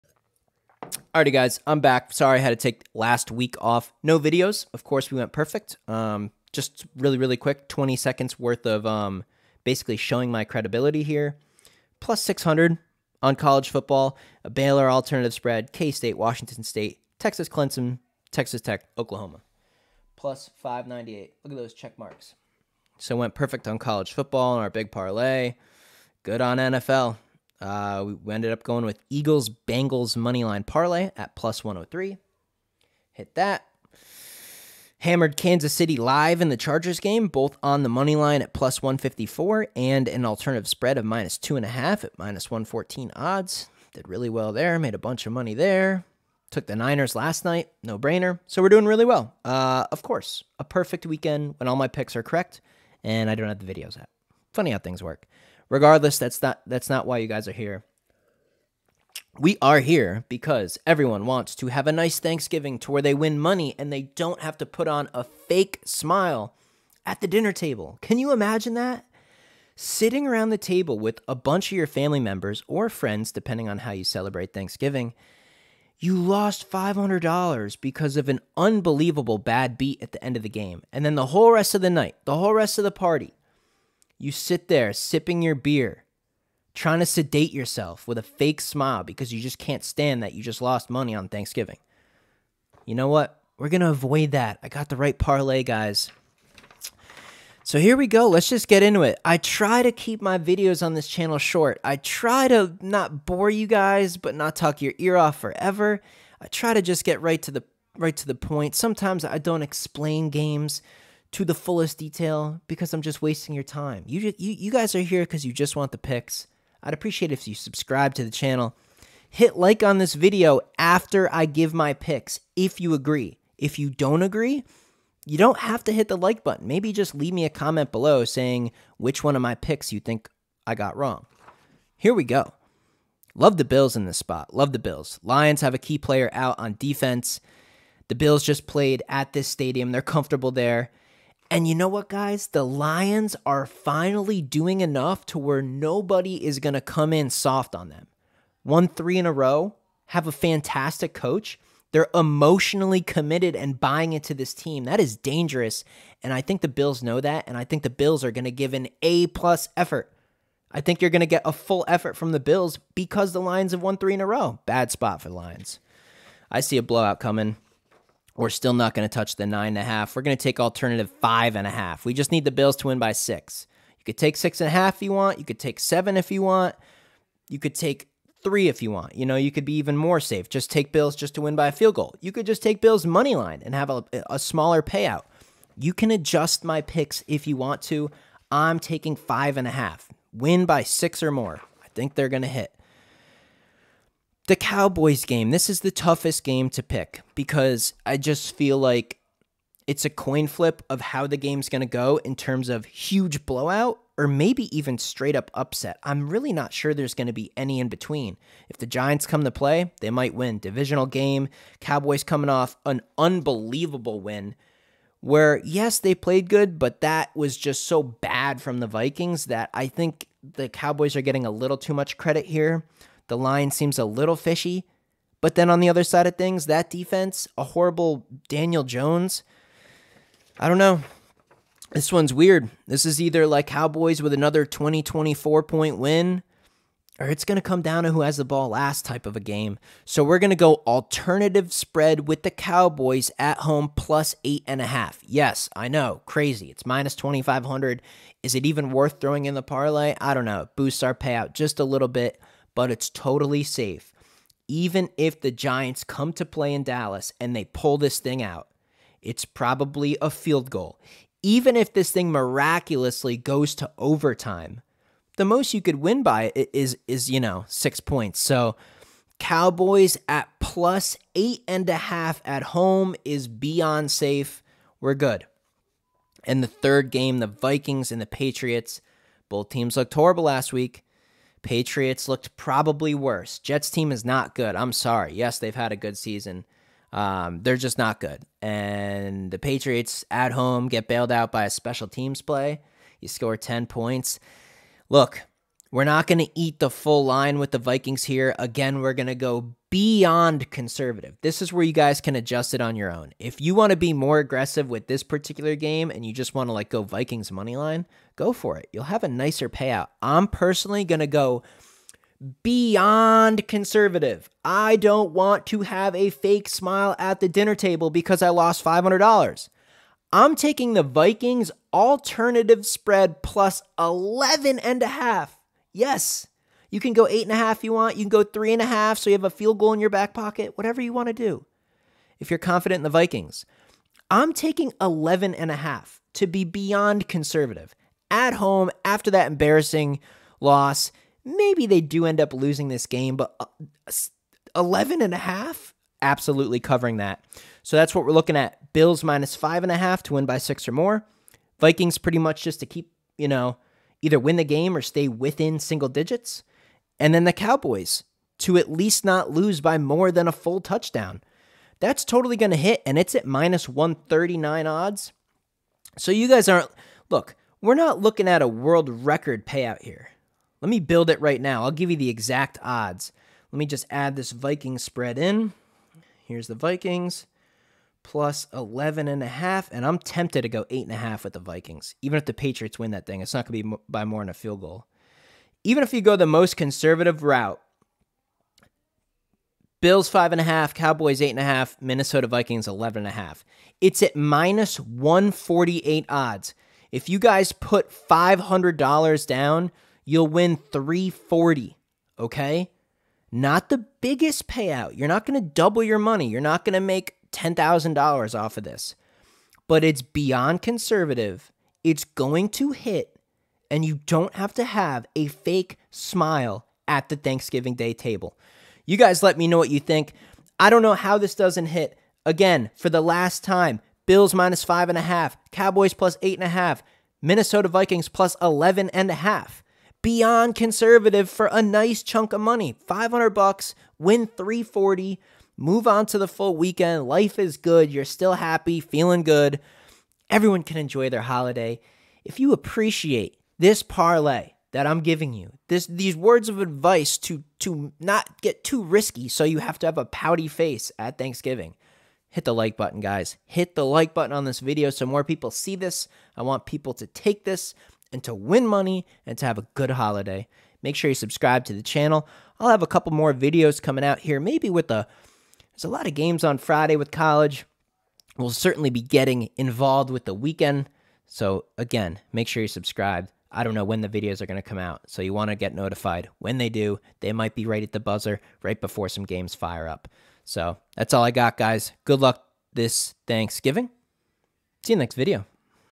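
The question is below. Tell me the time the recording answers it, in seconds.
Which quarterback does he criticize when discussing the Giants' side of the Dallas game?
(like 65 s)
228 s.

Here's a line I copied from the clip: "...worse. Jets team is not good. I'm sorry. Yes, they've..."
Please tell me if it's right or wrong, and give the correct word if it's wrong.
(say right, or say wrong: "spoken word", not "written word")
right.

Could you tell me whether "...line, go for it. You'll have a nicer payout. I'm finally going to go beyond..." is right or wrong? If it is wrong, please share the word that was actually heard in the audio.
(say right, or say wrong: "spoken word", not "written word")
wrong: "personally", not "finally".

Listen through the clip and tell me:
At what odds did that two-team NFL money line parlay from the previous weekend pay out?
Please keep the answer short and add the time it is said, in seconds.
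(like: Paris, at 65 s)
+103, at 31 s.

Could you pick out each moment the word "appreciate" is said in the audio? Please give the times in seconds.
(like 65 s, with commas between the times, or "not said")
116 s, 442 s.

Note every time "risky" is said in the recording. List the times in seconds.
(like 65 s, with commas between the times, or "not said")
449 s.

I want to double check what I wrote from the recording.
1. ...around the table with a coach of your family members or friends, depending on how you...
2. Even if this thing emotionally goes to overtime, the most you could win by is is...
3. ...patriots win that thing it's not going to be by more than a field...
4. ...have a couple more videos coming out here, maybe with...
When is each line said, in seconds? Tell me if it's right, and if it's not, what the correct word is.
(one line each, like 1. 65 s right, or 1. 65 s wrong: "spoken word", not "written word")
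1. 70 s wrong: "bunch", not "coach"
2. 261 s wrong: "miraculously", not "emotionally"
3. 382 s right
4. 462 s right.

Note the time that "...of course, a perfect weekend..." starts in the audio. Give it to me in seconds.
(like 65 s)
49 s.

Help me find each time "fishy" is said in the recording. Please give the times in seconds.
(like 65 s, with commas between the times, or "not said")
224 s.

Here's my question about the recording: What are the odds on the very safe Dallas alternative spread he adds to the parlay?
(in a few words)
-2500.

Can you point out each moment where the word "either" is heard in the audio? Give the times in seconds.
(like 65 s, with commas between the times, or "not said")
233 s, 354 s.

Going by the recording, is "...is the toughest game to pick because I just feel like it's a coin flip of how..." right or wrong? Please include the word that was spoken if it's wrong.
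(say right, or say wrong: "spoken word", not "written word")
right.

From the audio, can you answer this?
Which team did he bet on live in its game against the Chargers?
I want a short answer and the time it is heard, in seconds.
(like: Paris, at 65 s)
Kansas City, at 35 s.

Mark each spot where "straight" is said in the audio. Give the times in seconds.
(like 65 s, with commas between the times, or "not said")
204 s.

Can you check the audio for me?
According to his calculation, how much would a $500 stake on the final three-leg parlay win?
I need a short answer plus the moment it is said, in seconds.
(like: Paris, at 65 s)
$340, at 400 s.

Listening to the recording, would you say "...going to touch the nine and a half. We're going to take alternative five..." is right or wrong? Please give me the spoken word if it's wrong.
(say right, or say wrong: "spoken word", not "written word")
right.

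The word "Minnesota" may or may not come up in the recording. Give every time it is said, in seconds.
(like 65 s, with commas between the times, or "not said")
392 s, 427 s.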